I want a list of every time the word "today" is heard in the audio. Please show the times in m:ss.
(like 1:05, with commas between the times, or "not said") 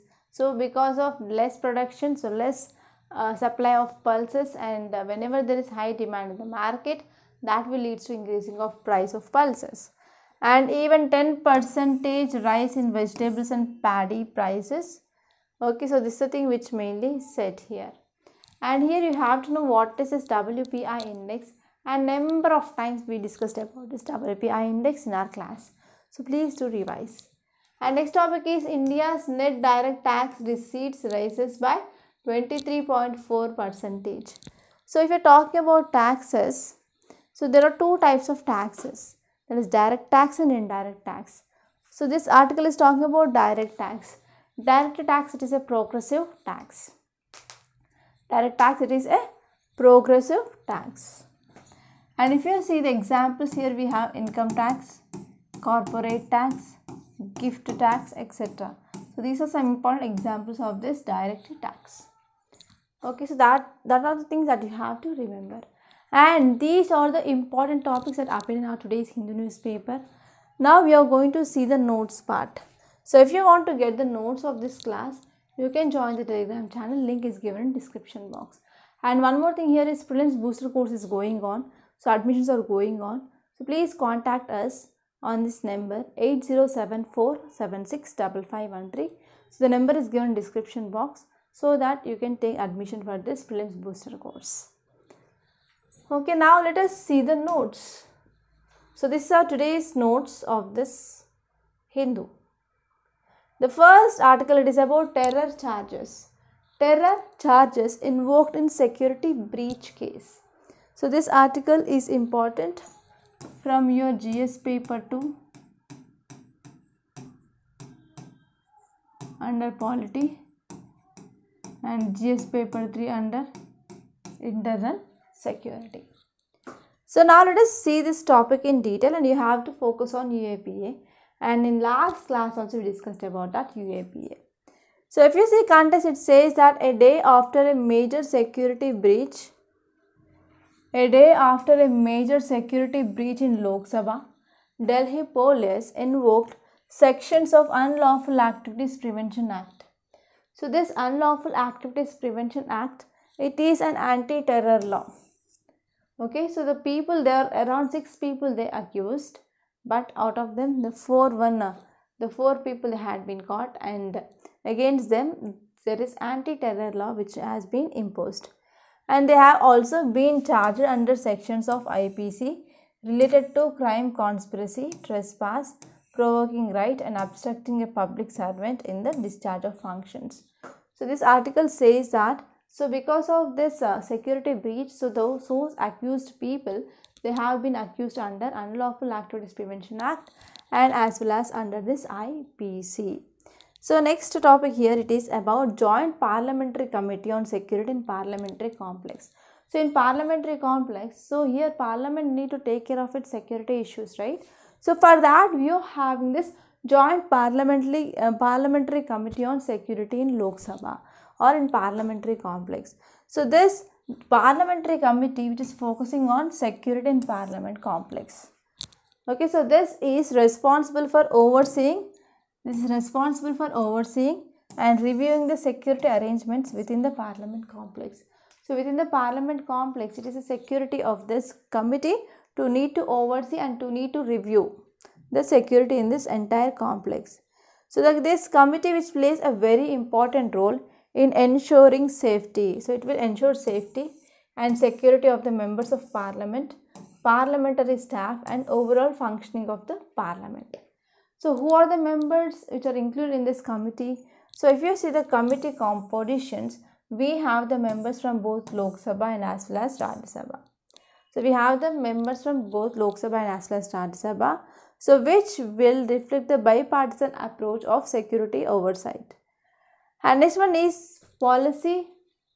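1:08, 1:39.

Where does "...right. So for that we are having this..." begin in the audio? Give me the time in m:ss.
3:24.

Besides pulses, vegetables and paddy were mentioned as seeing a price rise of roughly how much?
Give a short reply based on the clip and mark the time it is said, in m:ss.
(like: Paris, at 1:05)
10 percent, at 0:11.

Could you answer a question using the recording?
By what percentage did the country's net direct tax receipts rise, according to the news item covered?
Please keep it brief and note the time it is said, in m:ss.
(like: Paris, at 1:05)
23.4 percent, at 0:32.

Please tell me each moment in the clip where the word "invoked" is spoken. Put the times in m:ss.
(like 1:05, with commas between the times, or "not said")
1:47, 2:25.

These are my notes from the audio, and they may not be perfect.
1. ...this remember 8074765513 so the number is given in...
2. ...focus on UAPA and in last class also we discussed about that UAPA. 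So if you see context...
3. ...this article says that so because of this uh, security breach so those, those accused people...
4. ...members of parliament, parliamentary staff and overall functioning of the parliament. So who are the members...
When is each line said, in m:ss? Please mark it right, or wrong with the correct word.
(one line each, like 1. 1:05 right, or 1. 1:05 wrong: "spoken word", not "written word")
1. 1:25 wrong: "number", not "remember"
2. 2:09 right
3. 3:01 right
4. 4:05 right.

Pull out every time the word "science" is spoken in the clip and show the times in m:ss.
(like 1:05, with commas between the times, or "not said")
not said.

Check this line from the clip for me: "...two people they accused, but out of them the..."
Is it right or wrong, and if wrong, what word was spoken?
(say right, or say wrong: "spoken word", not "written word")
wrong: "six", not "two".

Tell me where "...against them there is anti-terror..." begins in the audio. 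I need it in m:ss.
2:44.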